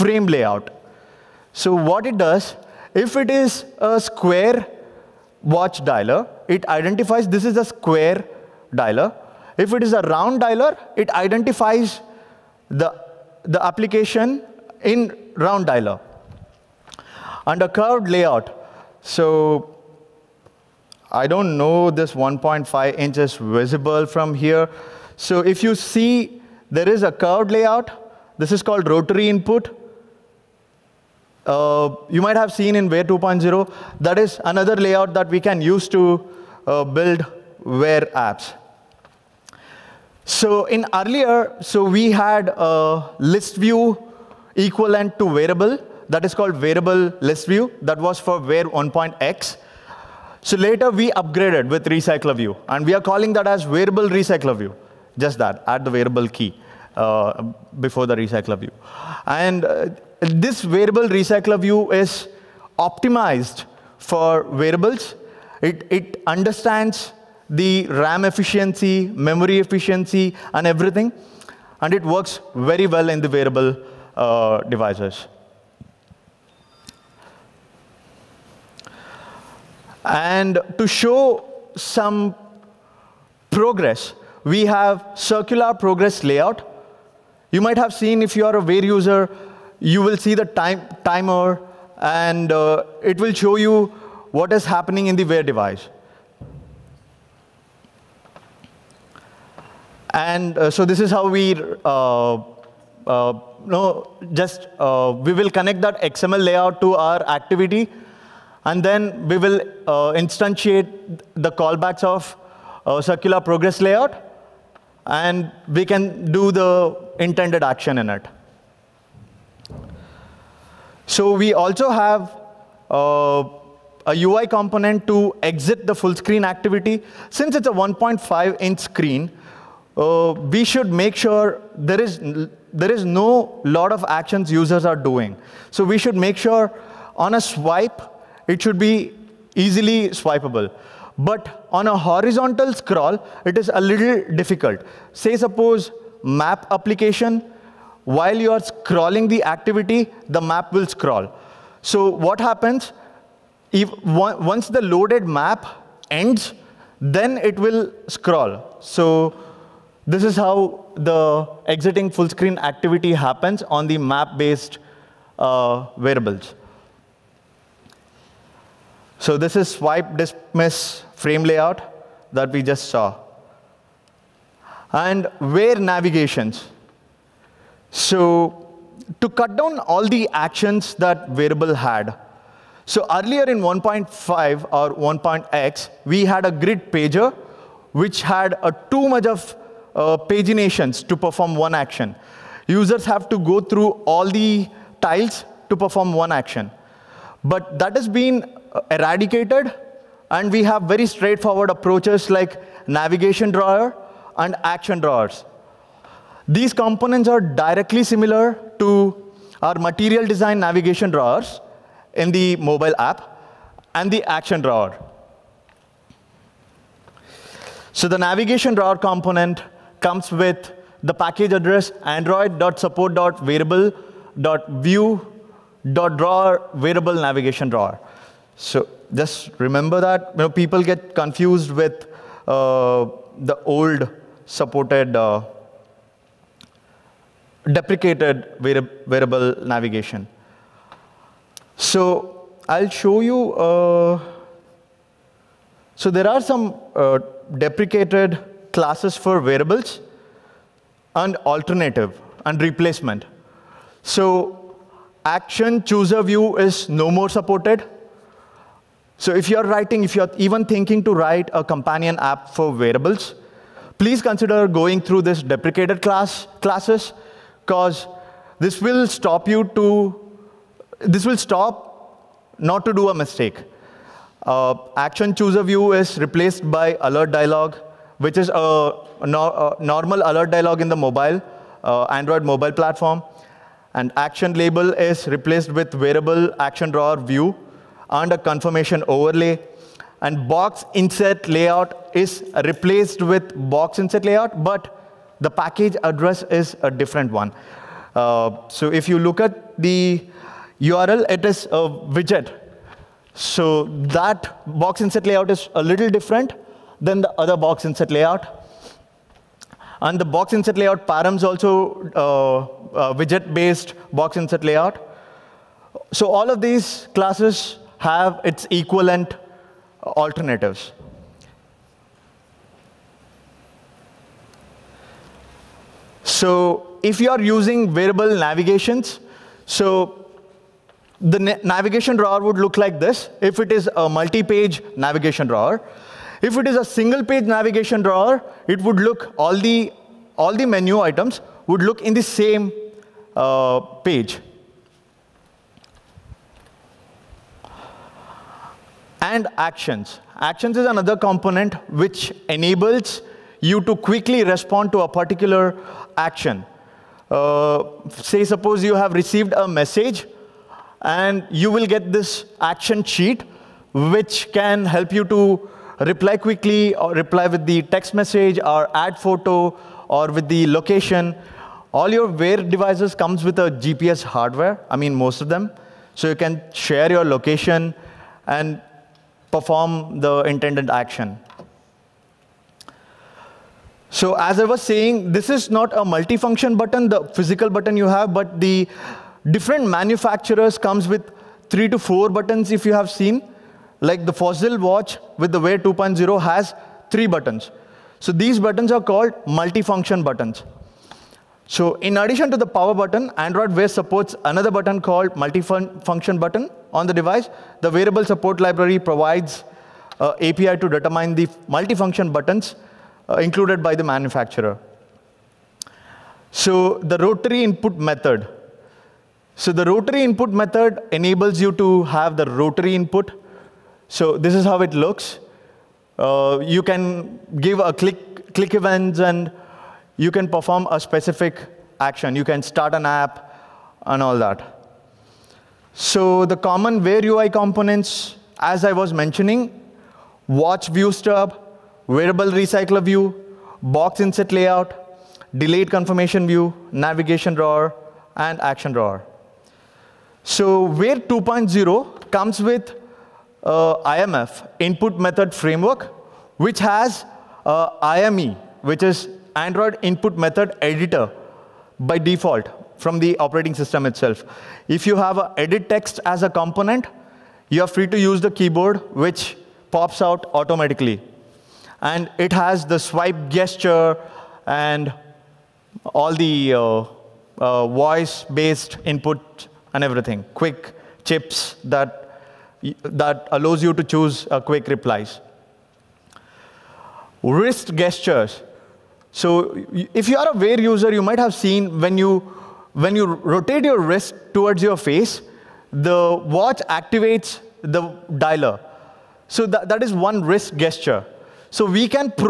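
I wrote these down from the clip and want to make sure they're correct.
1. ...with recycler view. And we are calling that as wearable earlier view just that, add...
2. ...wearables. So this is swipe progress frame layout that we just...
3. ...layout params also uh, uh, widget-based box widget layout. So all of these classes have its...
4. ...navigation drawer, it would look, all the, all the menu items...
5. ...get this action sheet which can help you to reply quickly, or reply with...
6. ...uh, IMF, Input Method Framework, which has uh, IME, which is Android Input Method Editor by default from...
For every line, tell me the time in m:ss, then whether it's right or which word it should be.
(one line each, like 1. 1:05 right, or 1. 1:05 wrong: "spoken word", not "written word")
1. 0:51 wrong: "recycler", not "earlier"
2. 2:45 wrong: "dismiss", not "progress"
3. 5:10 wrong: "inset", not "widget"
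4. 5:37 right
5. 6:01 right
6. 7:33 right.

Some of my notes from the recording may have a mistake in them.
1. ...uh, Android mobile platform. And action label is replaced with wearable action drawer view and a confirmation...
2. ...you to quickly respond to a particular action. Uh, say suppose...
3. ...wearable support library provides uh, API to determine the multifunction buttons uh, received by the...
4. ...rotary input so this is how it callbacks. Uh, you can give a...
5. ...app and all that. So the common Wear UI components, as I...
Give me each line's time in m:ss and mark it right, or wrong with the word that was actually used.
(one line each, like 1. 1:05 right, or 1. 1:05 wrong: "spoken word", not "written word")
1. 4:41 right
2. 5:53 right
3. 6:47 wrong: "included", not "received"
4. 7:02 wrong: "looks", not "callbacks"
5. 7:13 right.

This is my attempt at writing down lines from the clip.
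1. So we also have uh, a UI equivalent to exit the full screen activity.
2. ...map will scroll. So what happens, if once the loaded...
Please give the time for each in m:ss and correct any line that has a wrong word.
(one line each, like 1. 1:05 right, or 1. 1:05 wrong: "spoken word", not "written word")
1. 2:01 wrong: "component", not "equivalent"
2. 2:30 right.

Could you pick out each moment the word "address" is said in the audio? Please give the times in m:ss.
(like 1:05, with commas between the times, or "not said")
3:41, 4:56.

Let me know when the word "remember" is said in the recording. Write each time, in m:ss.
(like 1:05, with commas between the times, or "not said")
3:49.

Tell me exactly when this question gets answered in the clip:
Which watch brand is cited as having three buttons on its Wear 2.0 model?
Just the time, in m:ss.
6:34.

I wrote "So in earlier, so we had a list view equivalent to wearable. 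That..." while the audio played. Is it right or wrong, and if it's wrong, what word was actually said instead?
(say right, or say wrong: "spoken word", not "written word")
right.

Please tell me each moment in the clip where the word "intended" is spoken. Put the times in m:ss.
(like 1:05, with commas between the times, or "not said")
1:57, 6:20.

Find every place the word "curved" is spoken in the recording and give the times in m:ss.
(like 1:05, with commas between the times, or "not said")
0:17, 0:27.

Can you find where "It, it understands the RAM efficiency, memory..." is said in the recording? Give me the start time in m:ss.
1:05.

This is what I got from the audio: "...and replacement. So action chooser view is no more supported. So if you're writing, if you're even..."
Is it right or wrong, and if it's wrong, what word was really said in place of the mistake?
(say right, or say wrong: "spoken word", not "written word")
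right.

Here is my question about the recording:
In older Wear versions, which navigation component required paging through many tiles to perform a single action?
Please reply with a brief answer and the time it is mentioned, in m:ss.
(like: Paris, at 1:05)
grid pager, at 3:06.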